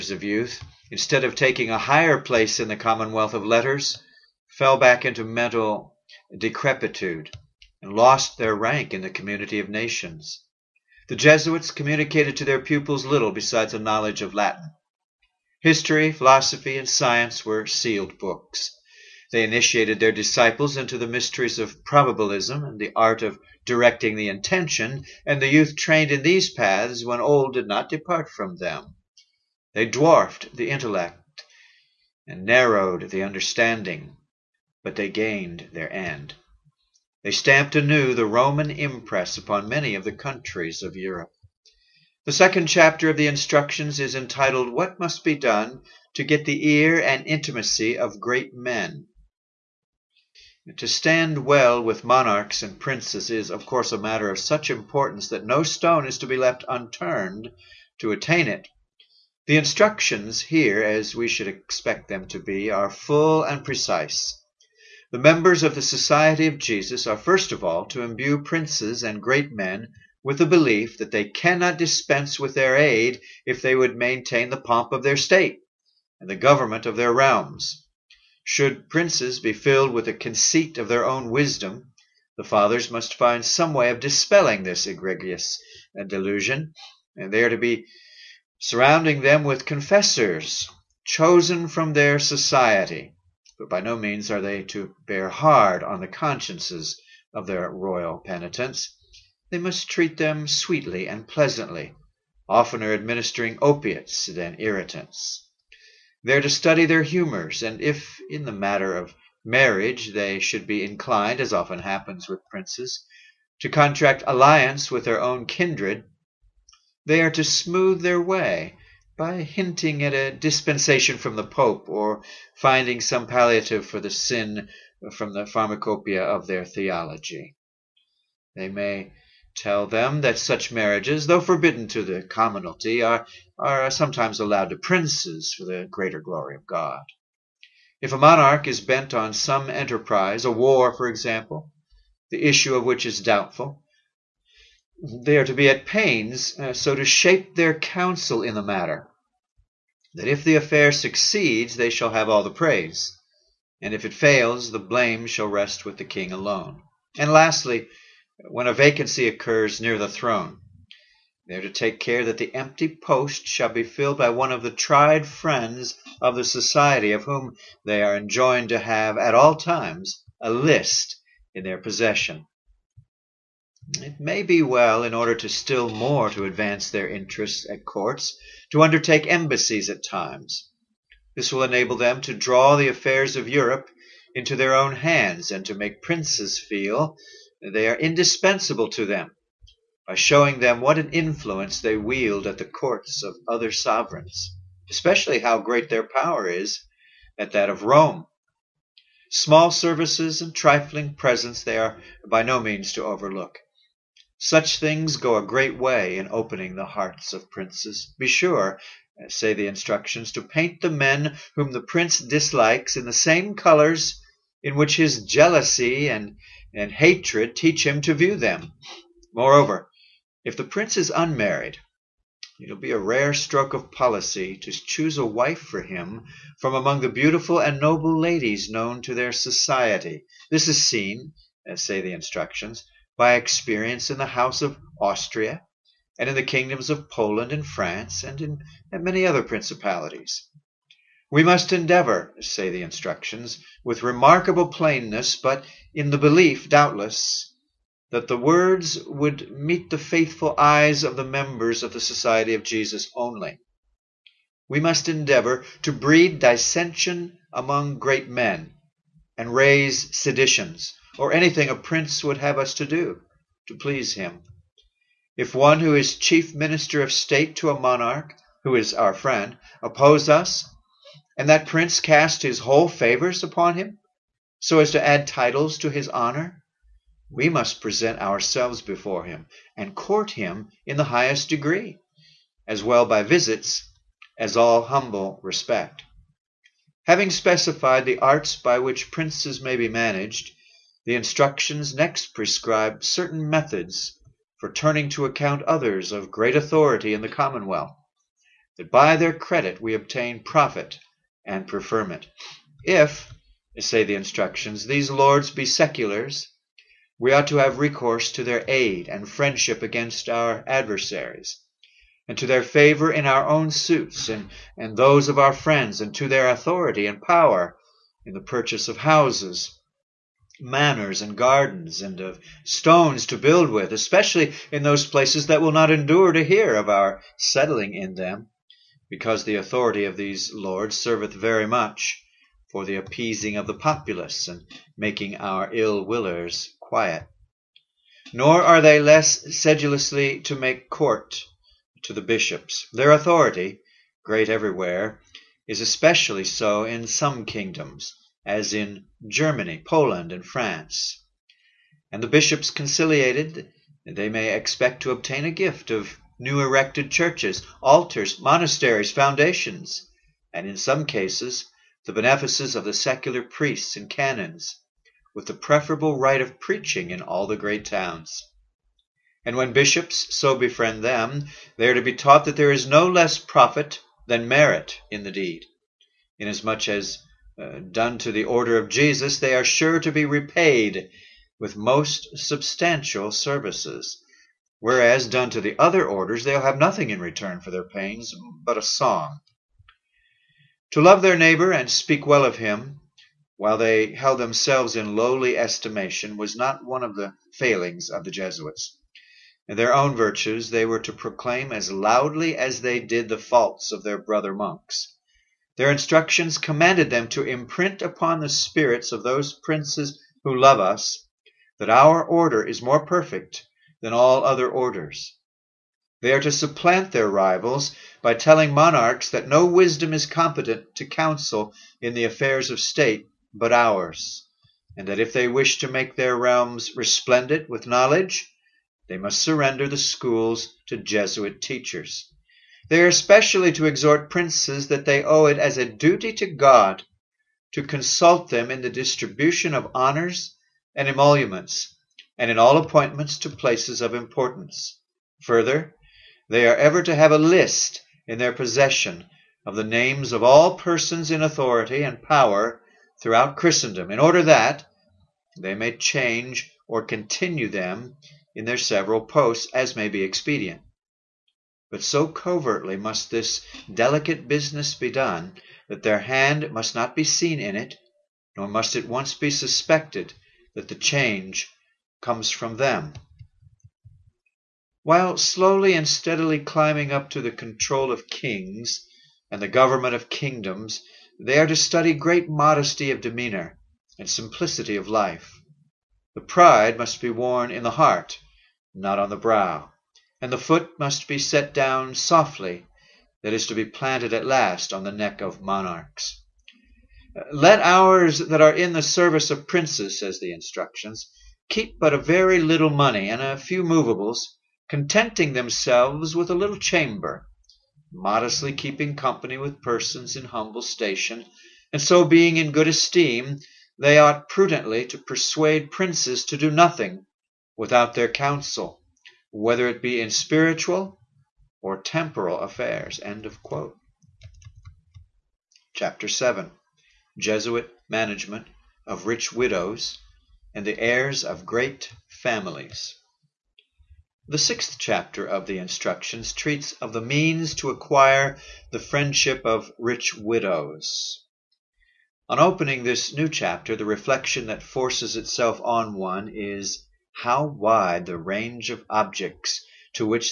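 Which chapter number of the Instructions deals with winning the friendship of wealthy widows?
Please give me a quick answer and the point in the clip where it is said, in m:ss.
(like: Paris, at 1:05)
sixth, at 8:54.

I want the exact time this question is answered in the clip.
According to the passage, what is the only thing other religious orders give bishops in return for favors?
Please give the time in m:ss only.
6:28.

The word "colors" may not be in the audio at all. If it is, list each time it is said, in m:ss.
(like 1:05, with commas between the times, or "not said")
3:33.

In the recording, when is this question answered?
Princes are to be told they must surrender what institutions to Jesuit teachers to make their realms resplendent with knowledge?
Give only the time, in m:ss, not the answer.
7:09.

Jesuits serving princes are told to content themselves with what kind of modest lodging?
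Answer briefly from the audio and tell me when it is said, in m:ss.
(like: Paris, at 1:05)
a little chamber, at 8:26.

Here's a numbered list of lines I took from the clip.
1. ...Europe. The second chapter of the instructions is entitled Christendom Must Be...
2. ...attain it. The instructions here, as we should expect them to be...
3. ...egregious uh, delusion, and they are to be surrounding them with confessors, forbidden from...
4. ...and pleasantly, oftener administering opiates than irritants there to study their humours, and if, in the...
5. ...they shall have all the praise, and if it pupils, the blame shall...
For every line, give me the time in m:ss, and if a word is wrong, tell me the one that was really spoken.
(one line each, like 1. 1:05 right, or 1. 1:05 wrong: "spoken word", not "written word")
1. 0:40 wrong: "What", not "Christendom"
2. 0:58 right
3. 1:24 wrong: "chosen", not "forbidden"
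4. 1:41 right
5. 2:31 wrong: "fails", not "pupils".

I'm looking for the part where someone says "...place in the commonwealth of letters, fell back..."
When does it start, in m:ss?
0:02.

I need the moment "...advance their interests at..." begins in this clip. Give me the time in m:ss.
2:56.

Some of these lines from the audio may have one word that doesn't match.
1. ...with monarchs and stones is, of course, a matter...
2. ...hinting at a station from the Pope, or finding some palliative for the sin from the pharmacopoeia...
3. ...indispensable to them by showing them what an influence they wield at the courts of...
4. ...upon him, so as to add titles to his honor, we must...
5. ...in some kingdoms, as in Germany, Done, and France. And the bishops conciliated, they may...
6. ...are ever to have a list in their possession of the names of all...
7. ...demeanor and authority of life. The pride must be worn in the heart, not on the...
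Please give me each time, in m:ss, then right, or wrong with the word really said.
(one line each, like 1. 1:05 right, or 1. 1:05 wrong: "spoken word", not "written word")
1. 0:51 wrong: "princes", not "stones"
2. 1:59 wrong: "dispensation", not "station"
3. 3:07 right
4. 4:33 right
5. 5:46 wrong: "Poland", not "Done"
6. 7:26 right
7. 8:03 wrong: "simplicity", not "authority".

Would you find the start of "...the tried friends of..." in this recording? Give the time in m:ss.
2:44.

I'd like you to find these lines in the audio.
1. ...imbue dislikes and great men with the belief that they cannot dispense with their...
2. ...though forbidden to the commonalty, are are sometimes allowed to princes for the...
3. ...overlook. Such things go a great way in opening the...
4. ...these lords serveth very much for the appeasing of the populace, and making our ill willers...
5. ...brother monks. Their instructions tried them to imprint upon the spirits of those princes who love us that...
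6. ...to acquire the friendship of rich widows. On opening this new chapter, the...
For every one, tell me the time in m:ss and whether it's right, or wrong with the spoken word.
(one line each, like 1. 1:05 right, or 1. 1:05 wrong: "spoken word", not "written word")
1. 1:08 wrong: "princes", not "dislikes"
2. 2:11 right
3. 3:23 right
4. 5:30 right
5. 6:44 wrong: "commanded", not "tried"
6. 8:57 right.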